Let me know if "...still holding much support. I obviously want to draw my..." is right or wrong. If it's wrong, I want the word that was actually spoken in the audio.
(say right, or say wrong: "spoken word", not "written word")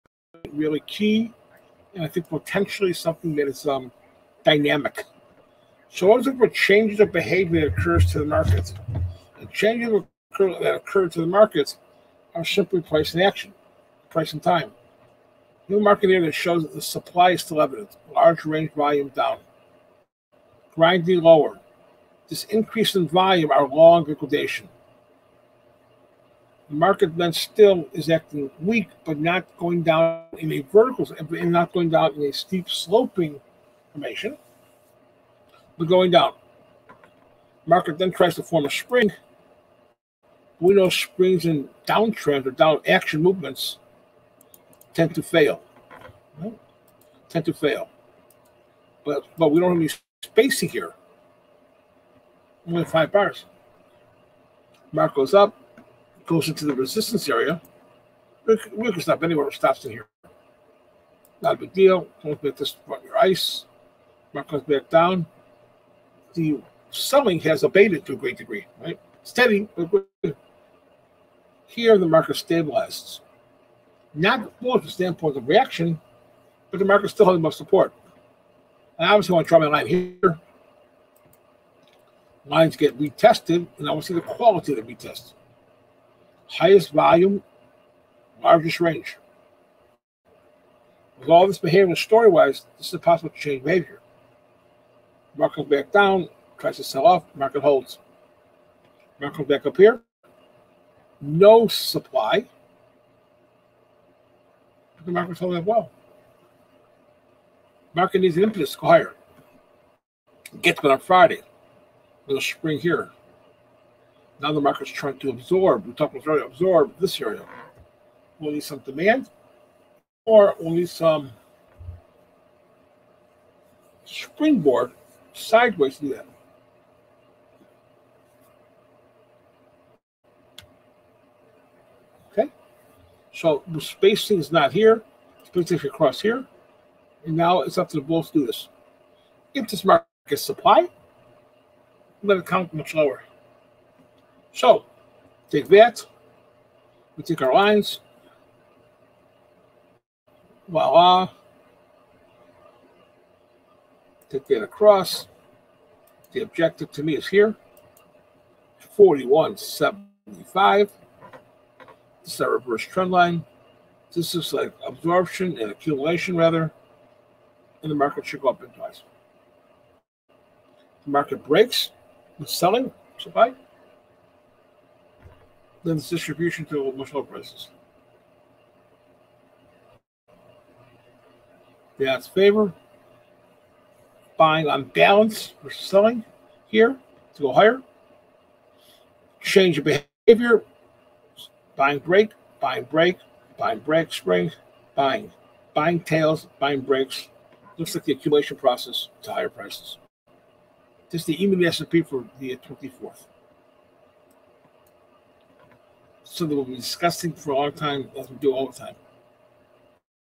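right.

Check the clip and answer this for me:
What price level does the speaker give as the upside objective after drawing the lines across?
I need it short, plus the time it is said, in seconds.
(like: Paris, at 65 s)
41.75, at 158 s.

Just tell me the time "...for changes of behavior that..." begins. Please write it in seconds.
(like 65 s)
6 s.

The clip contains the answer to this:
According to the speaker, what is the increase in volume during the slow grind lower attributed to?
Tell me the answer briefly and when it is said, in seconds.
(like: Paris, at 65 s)
long liquidation, at 23 s.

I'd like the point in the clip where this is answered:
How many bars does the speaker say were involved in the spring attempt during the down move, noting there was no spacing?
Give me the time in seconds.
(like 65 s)
52 s.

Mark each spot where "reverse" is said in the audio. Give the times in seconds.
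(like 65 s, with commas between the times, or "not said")
162 s.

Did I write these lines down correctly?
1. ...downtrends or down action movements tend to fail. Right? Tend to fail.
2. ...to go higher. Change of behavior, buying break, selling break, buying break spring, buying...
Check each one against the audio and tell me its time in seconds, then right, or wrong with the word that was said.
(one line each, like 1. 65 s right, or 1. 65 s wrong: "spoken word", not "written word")
1. 41 s right
2. 187 s wrong: "buying", not "selling".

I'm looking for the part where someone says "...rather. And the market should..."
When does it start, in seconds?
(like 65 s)
166 s.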